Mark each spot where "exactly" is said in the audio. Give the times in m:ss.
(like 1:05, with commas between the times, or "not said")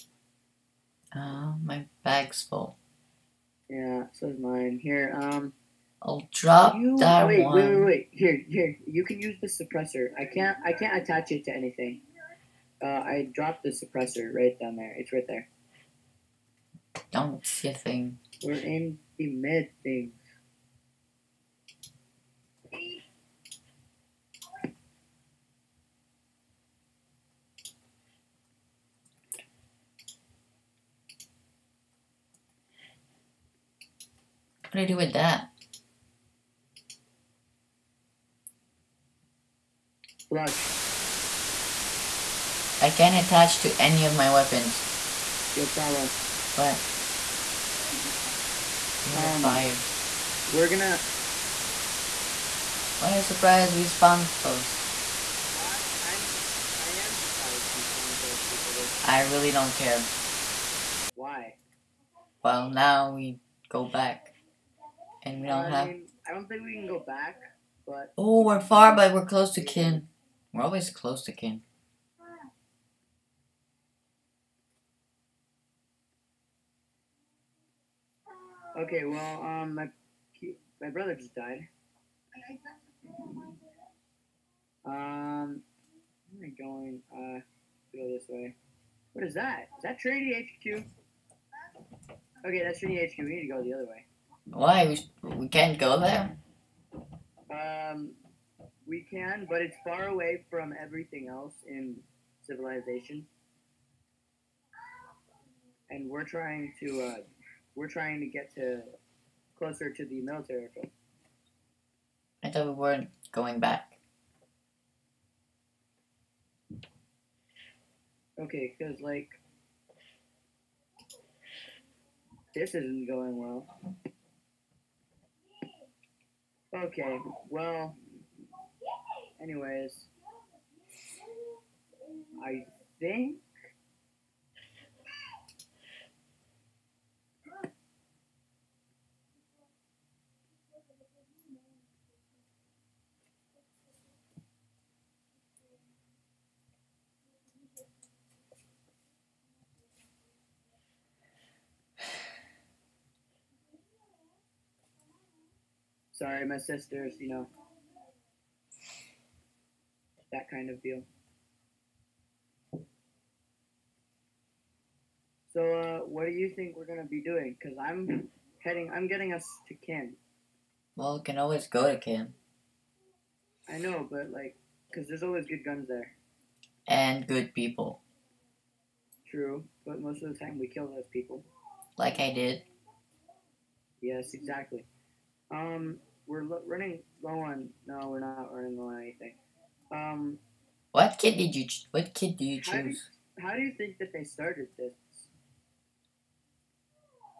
3:04.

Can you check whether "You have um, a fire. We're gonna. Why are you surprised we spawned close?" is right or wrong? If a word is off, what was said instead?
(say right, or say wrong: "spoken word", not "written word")
right.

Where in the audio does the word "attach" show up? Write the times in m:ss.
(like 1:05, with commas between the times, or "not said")
0:11, 0:43.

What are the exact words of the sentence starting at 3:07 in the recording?
No, we're not running low on anything.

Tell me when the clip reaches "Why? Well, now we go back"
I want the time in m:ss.
1:01.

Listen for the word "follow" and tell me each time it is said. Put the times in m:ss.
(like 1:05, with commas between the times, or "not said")
0:45.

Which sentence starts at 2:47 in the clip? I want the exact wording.
Cause I'm heading, I'm getting us to Ken.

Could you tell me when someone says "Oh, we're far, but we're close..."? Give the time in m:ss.
1:08.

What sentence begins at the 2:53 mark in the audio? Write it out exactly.
I know, but like, cause there's always good guns there.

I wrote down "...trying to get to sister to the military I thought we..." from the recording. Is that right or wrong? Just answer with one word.
wrong.